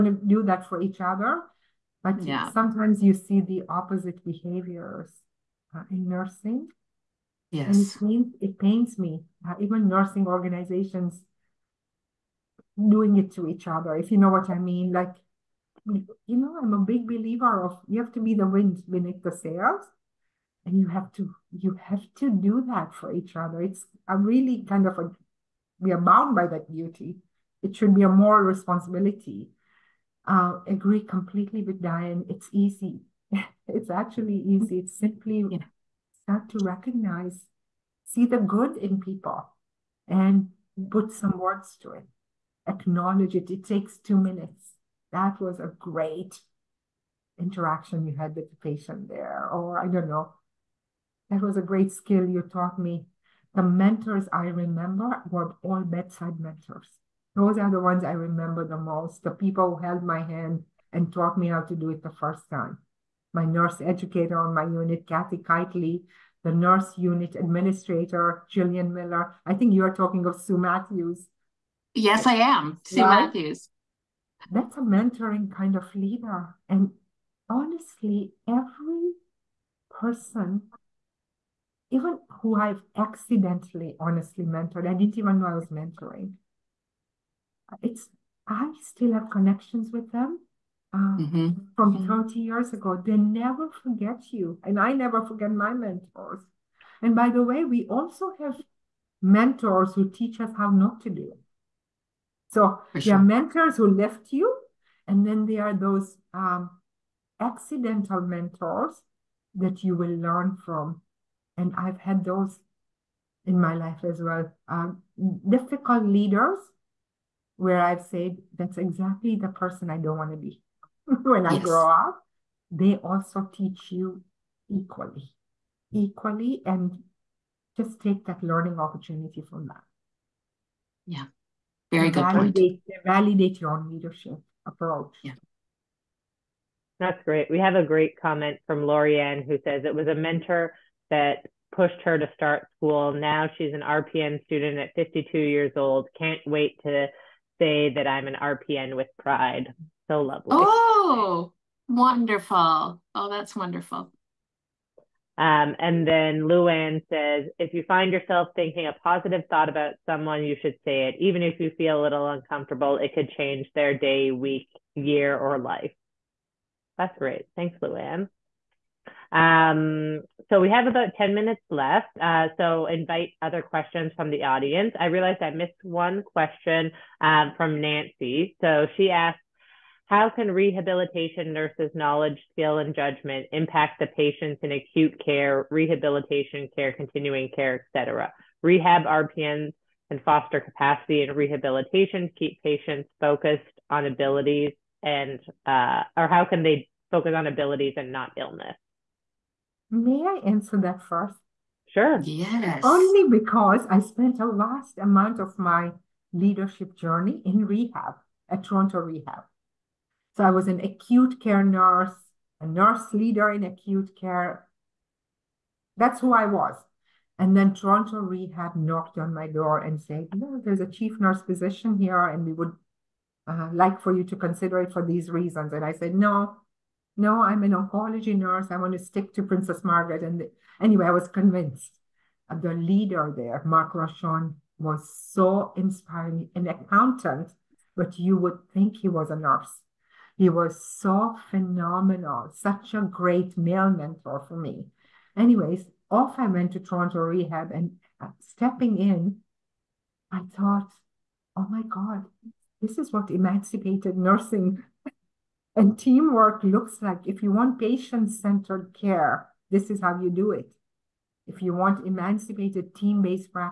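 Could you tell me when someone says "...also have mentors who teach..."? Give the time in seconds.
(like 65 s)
97 s.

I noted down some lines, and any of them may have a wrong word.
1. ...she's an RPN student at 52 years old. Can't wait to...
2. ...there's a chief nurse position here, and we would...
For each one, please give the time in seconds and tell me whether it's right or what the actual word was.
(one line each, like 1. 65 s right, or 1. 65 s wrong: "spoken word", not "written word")
1. 143 s right
2. 220 s right.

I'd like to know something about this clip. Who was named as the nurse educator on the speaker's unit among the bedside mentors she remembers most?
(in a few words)
Kathy Keitley.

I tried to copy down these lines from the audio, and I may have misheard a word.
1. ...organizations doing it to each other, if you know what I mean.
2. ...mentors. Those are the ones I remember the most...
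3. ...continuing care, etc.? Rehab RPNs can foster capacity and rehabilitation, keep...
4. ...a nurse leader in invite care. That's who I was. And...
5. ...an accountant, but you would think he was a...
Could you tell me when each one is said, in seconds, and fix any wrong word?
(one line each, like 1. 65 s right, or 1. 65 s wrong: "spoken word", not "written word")
1. 10 s right
2. 56 s right
3. 186 s right
4. 212 s wrong: "acute", not "invite"
5. 236 s right.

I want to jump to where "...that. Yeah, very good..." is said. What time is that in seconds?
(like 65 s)
129 s.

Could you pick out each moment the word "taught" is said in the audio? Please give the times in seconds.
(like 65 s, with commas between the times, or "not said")
52 s, 61 s.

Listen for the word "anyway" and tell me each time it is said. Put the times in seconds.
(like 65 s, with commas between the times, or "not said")
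230 s, 245 s.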